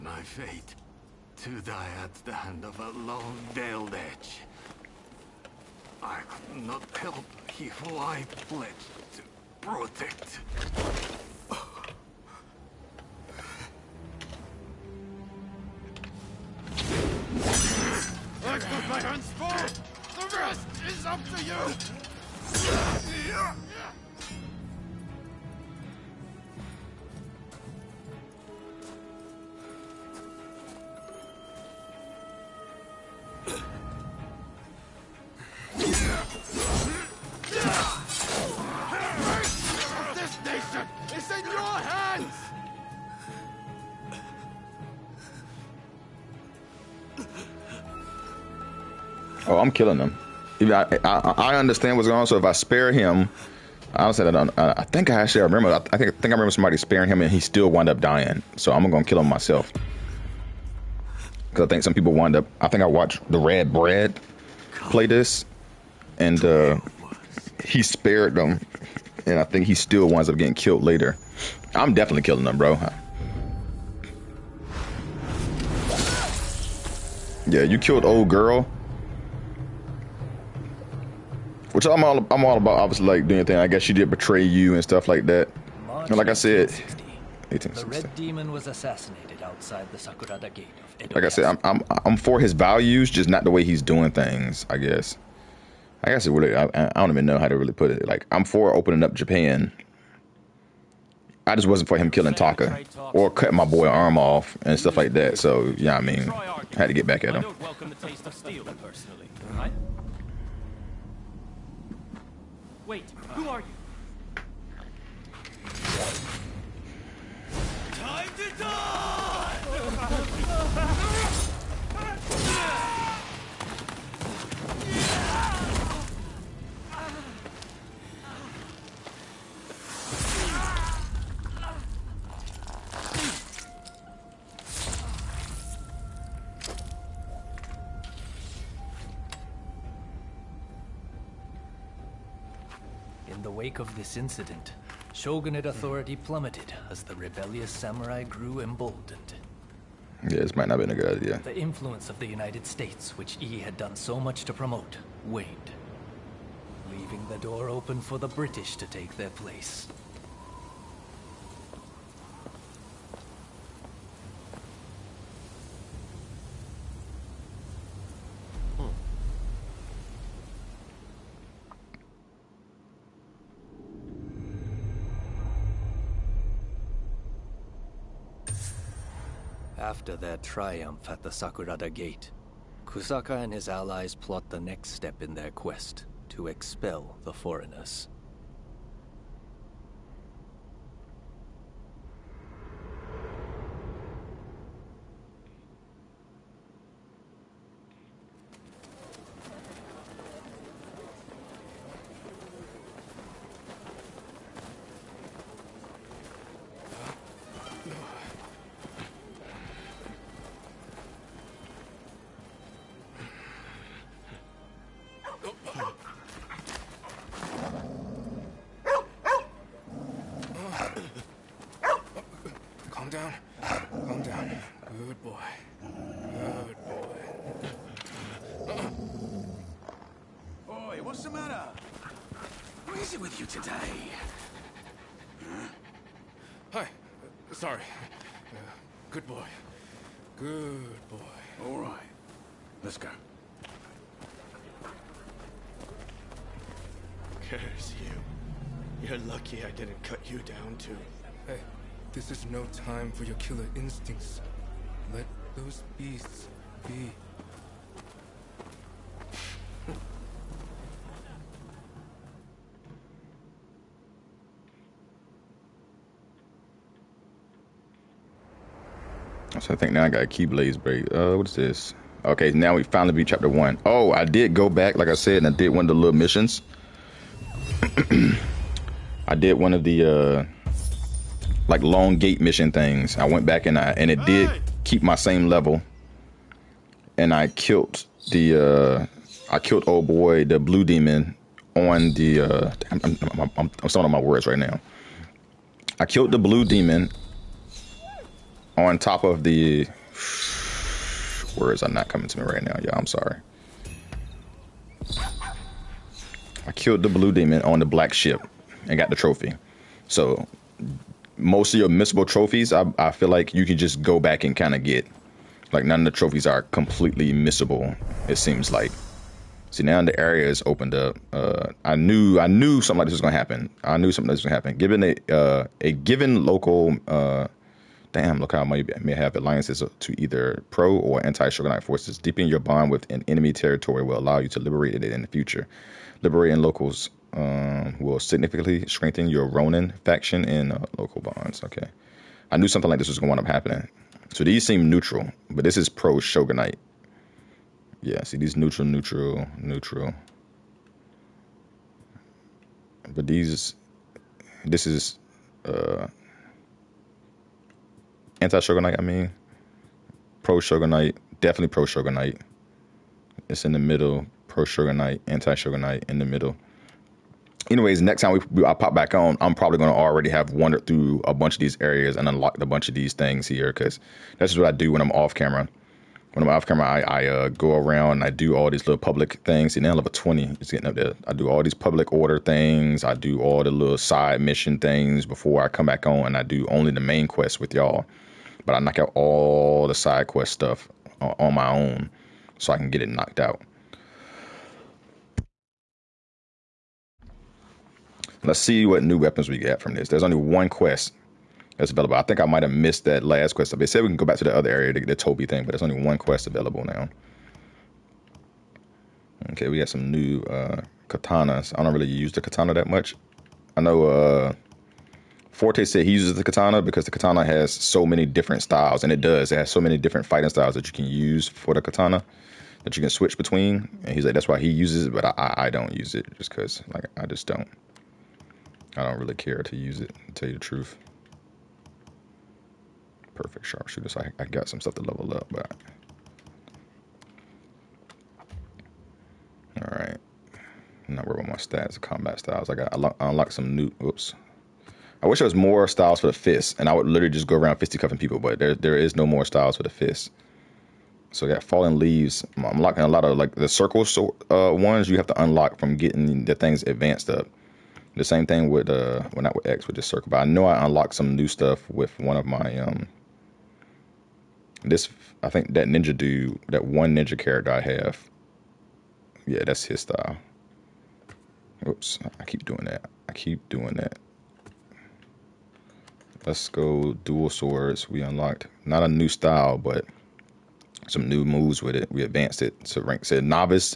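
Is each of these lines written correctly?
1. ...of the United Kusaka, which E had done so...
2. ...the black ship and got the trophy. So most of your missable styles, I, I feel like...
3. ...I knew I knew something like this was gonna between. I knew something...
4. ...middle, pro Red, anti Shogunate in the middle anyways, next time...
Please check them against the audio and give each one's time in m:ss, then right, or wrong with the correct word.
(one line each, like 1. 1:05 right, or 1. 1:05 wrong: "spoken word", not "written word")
1. 2:32 wrong: "States", not "Kusaka"
2. 5:07 wrong: "trophies", not "styles"
3. 5:21 wrong: "happen", not "between"
4. 6:03 wrong: "Shogunate", not "Red".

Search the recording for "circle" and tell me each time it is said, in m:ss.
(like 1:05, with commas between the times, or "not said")
7:33, 7:40.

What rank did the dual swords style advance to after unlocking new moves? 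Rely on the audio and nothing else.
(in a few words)
Novice.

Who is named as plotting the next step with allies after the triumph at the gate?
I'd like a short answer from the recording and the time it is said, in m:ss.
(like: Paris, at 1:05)
Kusaka, at 3:02.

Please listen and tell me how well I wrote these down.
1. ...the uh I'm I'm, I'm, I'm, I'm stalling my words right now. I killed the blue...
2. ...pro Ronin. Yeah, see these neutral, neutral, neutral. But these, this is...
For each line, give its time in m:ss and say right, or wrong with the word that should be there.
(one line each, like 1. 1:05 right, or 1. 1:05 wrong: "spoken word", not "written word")
1. 4:52 right
2. 5:45 wrong: "Shogunate", not "Ronin".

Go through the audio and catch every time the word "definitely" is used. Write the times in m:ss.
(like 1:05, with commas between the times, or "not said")
1:11, 6:01.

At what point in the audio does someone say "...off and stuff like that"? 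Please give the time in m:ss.
1:44.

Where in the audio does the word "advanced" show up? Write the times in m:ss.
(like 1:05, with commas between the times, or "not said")
7:36, 8:02.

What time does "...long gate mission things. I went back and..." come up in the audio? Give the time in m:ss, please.
4:41.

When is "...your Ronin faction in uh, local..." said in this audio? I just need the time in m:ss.
5:39.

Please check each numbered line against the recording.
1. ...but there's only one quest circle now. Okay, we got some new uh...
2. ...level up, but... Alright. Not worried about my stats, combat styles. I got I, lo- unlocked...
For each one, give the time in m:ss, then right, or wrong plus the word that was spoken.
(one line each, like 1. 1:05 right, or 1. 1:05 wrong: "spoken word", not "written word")
1. 6:45 wrong: "available", not "circle"
2. 7:15 right.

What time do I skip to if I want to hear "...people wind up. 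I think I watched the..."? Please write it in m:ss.
1:01.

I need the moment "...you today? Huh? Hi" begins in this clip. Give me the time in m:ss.
3:53.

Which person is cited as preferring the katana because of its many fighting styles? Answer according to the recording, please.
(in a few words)
Forte.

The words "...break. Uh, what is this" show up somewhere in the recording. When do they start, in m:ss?
4:30.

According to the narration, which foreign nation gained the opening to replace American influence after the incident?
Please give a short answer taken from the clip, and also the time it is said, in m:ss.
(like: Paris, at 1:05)
The British, at 2:38.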